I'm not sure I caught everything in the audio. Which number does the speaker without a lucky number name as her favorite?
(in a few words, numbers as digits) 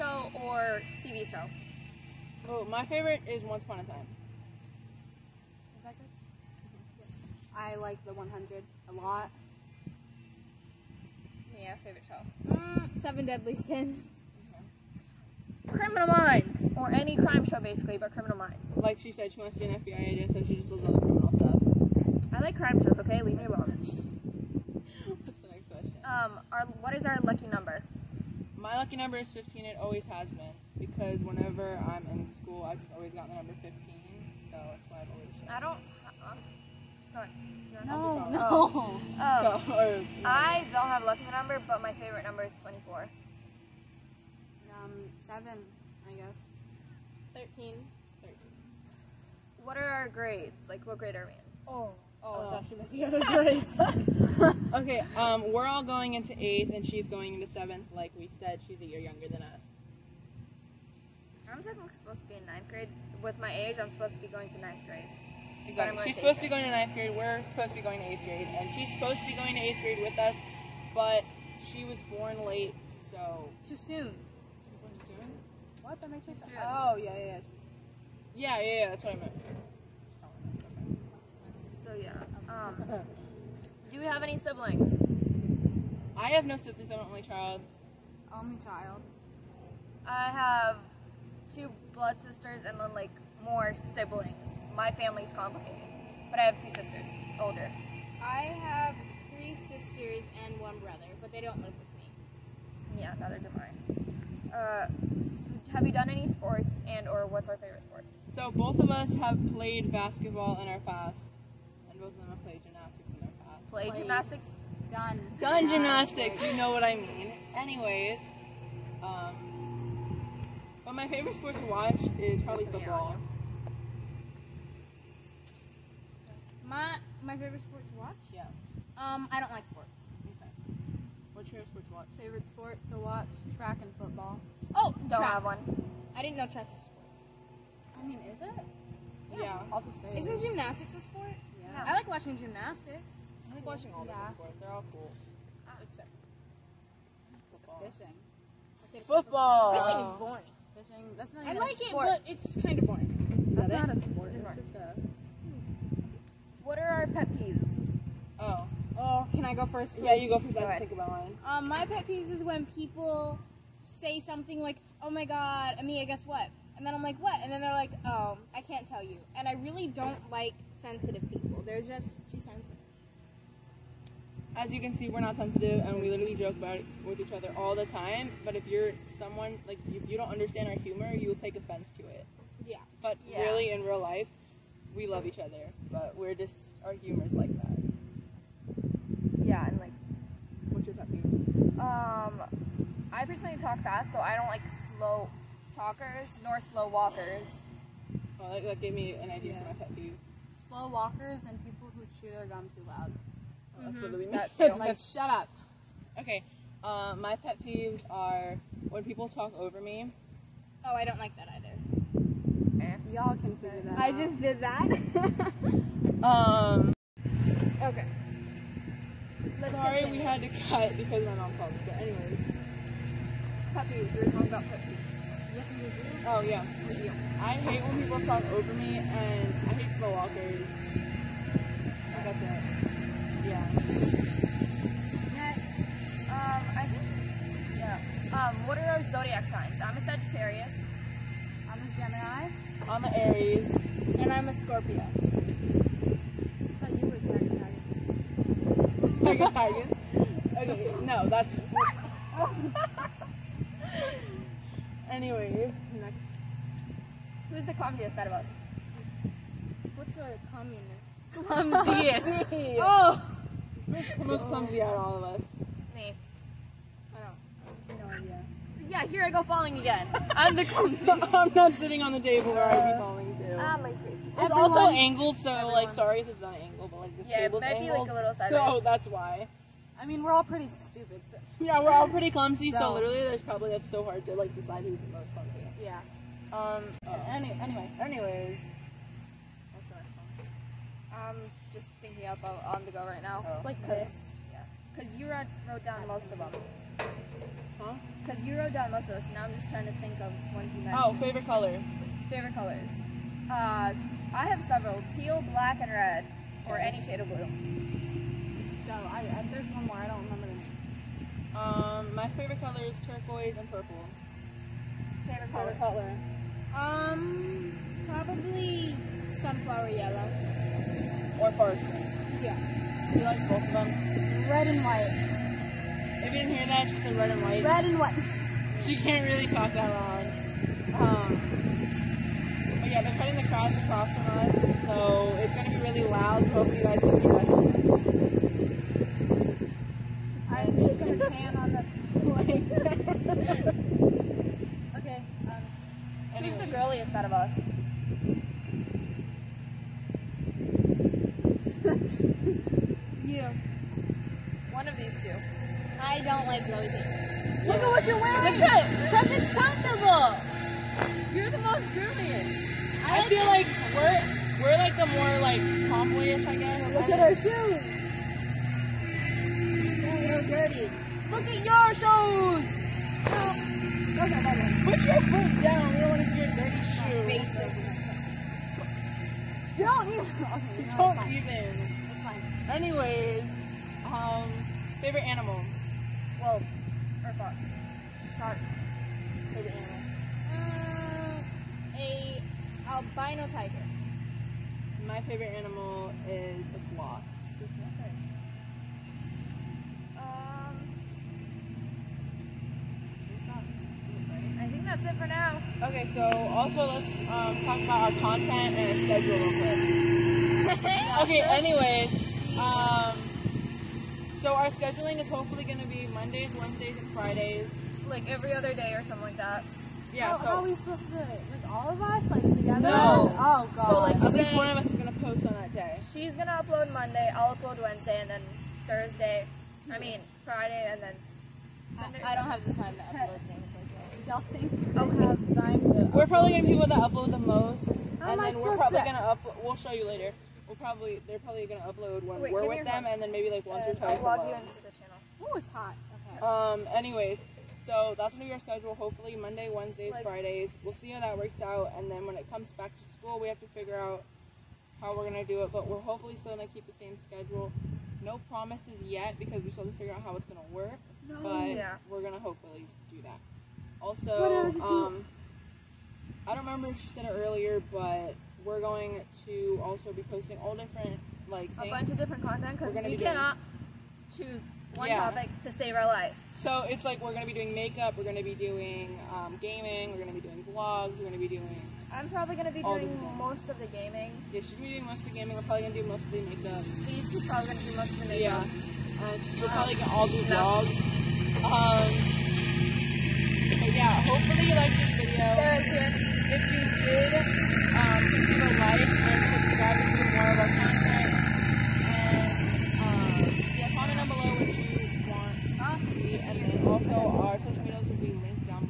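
24.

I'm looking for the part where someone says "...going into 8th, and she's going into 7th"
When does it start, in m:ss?
0:55.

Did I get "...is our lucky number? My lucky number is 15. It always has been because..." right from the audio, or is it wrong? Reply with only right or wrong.
right.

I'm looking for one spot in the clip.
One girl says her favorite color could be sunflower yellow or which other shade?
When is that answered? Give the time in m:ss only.
5:21.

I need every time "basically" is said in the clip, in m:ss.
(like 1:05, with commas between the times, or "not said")
0:17, 6:17.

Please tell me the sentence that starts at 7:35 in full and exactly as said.
But we're hopefully still gonna keep the same schedule.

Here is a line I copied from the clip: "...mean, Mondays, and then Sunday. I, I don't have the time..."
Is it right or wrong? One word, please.
wrong.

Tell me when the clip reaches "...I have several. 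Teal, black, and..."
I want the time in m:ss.
5:04.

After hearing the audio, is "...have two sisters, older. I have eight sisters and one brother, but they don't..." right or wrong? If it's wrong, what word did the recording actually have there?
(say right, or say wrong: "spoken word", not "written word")
wrong: "three", not "eight".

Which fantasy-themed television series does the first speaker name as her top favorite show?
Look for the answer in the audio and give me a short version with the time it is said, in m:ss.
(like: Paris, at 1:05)
Once Upon a Time, at 0:03.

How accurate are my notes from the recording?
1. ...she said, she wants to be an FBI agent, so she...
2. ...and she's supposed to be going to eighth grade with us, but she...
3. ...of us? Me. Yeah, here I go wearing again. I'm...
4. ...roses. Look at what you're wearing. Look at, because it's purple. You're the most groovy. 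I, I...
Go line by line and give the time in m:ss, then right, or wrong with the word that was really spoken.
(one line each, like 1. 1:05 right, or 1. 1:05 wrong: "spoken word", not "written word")
1. 0:18 right
2. 1:08 right
3. 4:25 wrong: "falling", not "wearing"
4. 5:56 wrong: "comfortable", not "purple".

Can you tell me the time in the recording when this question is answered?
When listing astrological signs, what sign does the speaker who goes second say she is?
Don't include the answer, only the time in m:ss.
4:01.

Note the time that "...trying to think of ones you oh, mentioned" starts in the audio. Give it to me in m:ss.
4:59.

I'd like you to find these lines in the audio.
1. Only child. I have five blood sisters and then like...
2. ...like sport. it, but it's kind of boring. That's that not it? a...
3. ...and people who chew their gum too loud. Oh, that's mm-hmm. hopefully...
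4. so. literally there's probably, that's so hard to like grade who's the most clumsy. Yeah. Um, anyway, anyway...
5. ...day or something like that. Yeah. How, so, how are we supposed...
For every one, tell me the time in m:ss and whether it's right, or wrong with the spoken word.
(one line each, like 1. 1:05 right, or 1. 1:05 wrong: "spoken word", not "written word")
1. 1:28 wrong: "two", not "five"
2. 2:31 right
3. 3:21 wrong: "literally", not "hopefully"
4. 4:42 wrong: "decide", not "grade"
5. 6:58 right.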